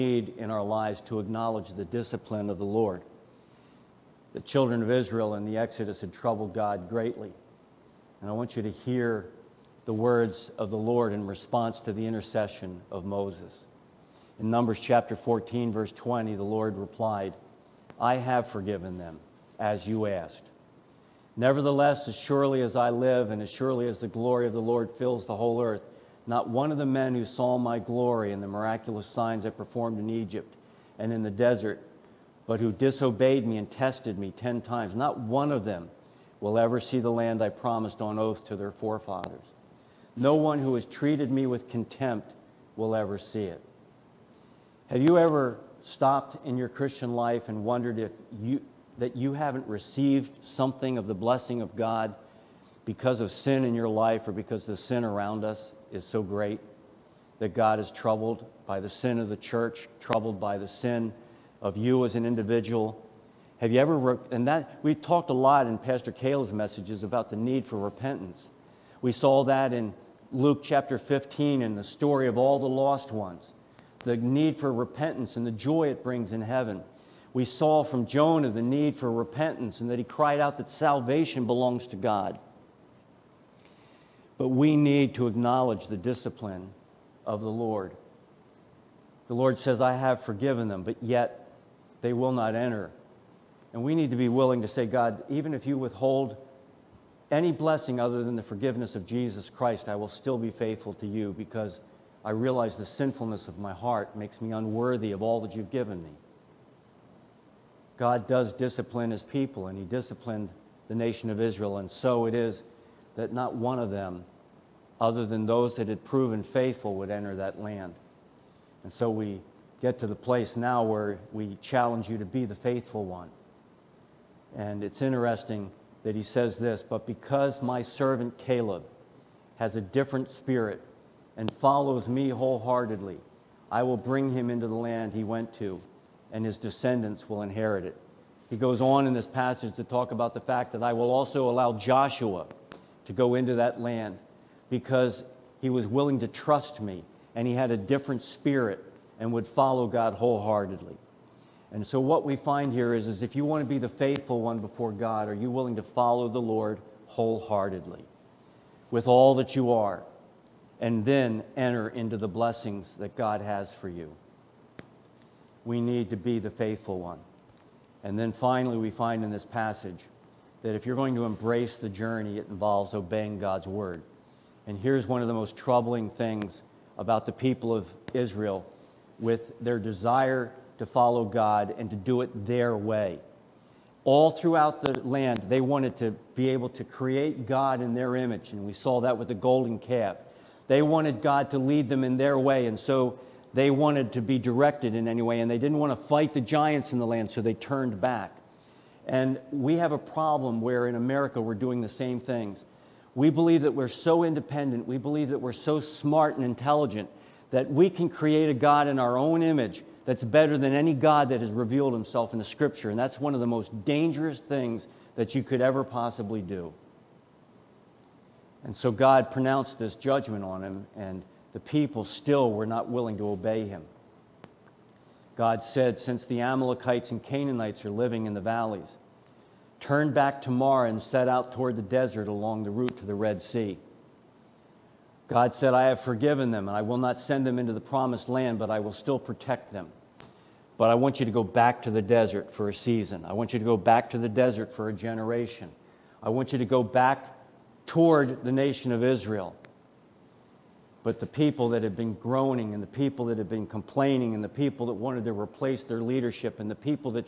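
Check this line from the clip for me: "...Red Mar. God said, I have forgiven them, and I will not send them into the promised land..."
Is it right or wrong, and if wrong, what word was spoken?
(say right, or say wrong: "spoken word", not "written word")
wrong: "Sea", not "Mar".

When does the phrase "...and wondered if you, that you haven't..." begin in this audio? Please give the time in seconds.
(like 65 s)
47 s.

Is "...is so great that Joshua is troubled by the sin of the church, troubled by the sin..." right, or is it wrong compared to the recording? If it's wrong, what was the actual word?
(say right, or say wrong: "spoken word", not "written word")
wrong: "God", not "Joshua".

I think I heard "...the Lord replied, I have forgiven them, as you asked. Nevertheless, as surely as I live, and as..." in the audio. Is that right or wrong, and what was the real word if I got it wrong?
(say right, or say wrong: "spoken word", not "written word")
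right.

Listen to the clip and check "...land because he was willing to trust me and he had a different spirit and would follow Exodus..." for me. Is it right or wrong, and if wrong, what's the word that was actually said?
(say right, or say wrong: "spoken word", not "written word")
wrong: "God", not "Exodus".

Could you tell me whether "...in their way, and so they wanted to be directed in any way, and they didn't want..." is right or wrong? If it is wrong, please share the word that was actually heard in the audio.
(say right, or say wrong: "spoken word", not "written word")
right.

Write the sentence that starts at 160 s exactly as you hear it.
and then enter into the blessings that God has for you.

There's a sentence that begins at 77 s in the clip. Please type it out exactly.
We saw from Jonah the need for repentance and that he cried out that salvation belongs to God.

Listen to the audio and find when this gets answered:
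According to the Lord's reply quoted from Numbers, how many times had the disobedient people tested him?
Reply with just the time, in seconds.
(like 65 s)
34 s.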